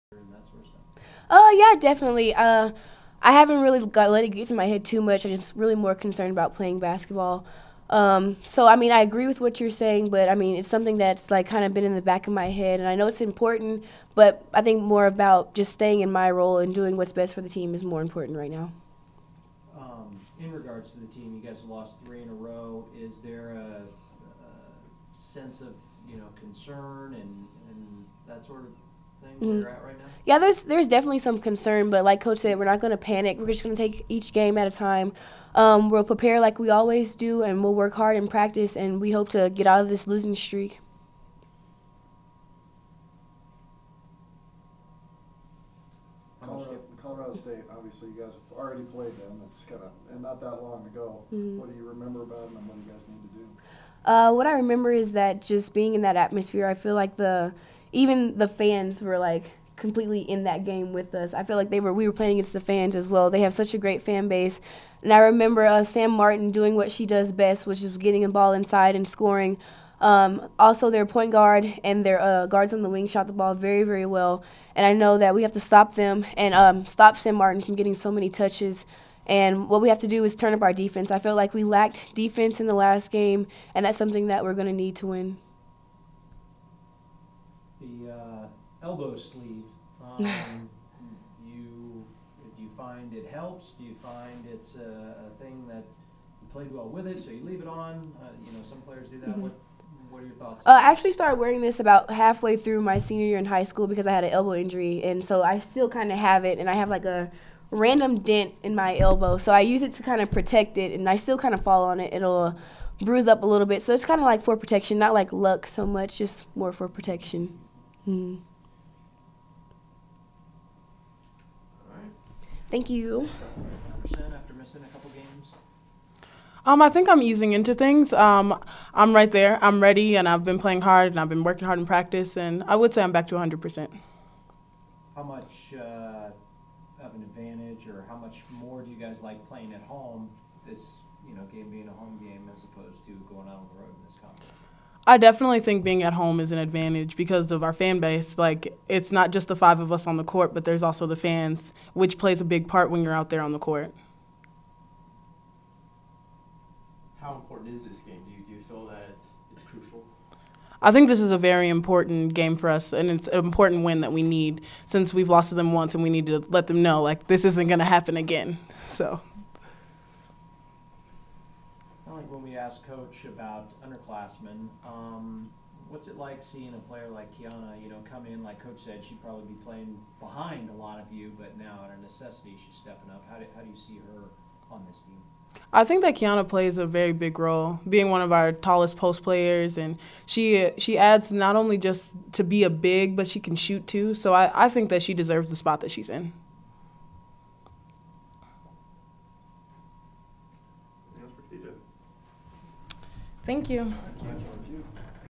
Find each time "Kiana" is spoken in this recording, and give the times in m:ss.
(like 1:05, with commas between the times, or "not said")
2:57, 3:06.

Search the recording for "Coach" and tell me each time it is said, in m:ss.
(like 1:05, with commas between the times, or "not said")
0:32, 2:52, 2:58.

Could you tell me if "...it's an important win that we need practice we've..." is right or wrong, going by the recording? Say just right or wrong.
wrong.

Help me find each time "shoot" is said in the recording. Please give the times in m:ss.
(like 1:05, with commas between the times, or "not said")
3:13.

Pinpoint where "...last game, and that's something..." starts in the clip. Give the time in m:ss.
1:22.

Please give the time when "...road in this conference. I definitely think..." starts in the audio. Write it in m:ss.
2:23.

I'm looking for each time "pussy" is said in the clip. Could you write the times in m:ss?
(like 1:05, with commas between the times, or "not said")
not said.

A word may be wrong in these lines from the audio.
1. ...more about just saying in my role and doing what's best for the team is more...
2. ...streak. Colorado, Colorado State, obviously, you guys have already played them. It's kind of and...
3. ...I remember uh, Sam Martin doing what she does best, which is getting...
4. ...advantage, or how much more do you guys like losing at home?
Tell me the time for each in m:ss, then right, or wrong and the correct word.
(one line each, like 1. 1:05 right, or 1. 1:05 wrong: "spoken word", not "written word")
1. 0:14 wrong: "staying", not "saying"
2. 0:40 right
3. 1:05 right
4. 2:17 wrong: "playing", not "losing".